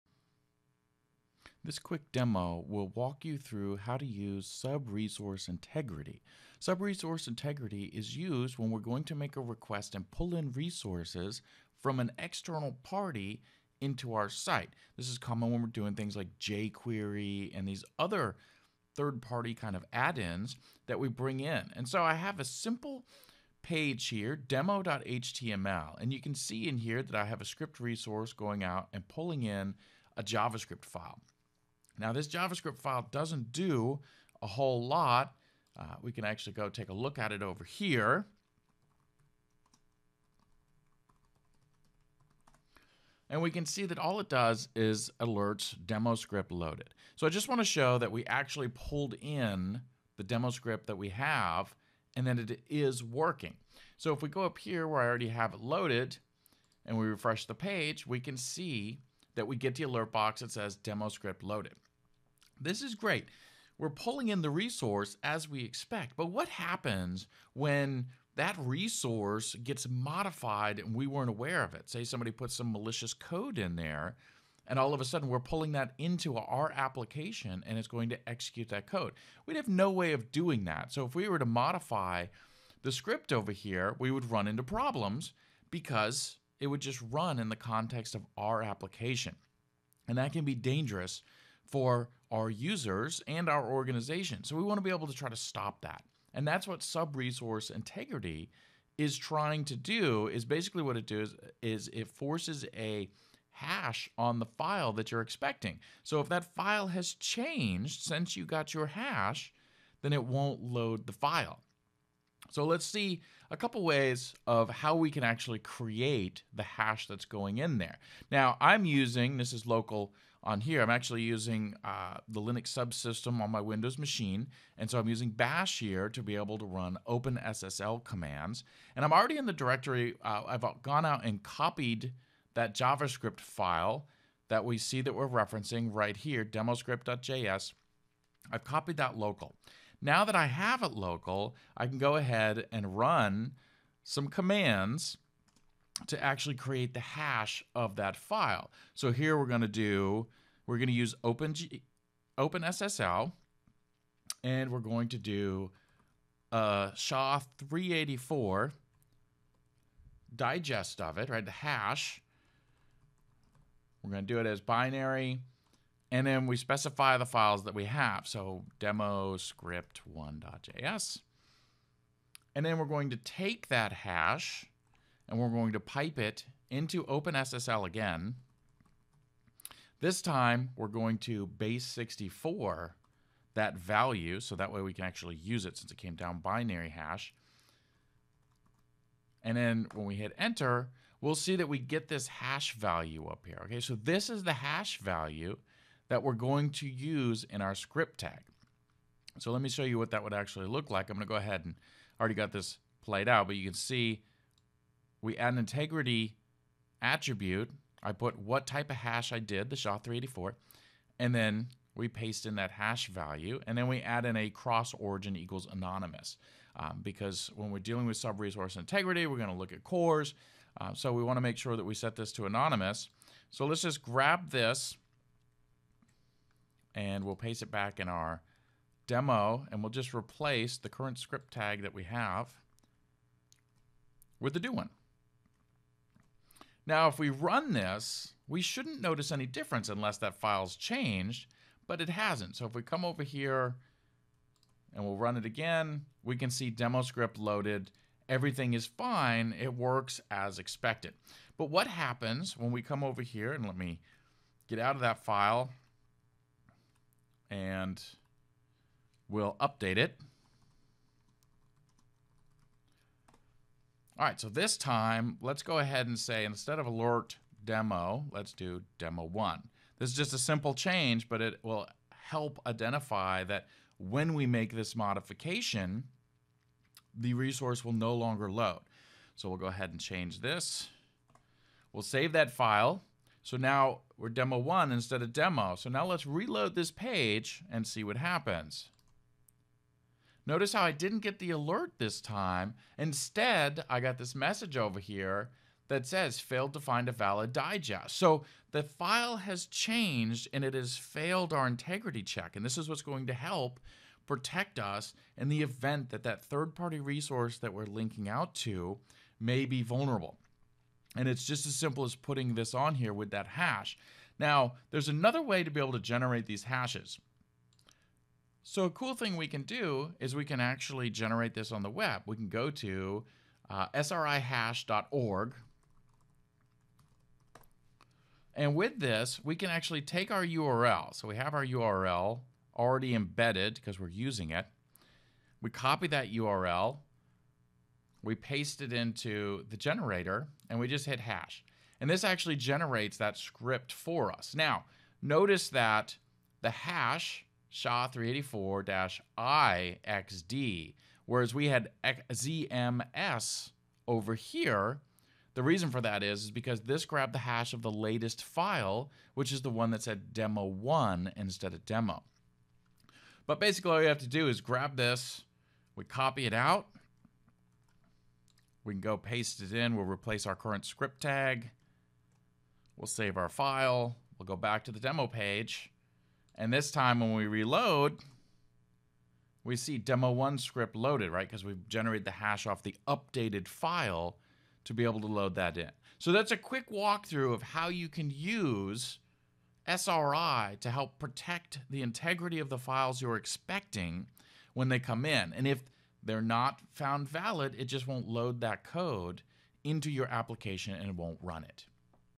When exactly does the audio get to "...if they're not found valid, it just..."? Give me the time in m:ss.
6:35.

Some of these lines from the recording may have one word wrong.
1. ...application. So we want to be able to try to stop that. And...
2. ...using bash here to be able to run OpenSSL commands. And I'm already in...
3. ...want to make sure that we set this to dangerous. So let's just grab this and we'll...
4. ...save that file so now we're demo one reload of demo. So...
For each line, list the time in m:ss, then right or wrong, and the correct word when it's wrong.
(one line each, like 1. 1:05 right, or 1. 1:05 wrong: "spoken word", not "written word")
1. 1:33 wrong: "organization", not "application"
2. 2:05 right
3. 3:41 wrong: "anonymous", not "dangerous"
4. 4:42 wrong: "instead", not "reload".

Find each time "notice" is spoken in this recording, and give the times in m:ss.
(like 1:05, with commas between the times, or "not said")
3:59, 4:50, 5:45.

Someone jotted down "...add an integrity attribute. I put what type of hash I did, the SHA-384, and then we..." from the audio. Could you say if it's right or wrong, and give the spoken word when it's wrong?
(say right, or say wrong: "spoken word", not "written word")
right.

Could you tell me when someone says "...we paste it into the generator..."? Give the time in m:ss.
5:38.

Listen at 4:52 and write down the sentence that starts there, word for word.
Instead, I got this message over here that says failed to find a valid digest.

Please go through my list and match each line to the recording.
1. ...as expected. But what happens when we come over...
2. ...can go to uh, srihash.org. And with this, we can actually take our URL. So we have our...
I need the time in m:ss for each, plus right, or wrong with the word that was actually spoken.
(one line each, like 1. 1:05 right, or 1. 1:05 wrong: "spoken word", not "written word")
1. 4:10 right
2. 5:22 right.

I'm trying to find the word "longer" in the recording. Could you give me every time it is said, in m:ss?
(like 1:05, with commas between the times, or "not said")
4:38.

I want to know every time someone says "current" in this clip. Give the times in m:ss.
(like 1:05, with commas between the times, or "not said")
3:50, 6:10.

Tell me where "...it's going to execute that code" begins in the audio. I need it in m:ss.
1:17.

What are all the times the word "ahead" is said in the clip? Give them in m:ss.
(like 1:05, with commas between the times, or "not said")
2:22, 3:21, 4:25, 4:39.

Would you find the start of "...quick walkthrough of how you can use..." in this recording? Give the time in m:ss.
6:26.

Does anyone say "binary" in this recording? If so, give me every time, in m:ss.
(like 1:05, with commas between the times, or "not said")
2:44, 3:06.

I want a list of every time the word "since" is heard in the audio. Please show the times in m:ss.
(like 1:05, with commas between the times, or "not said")
1:48, 3:05.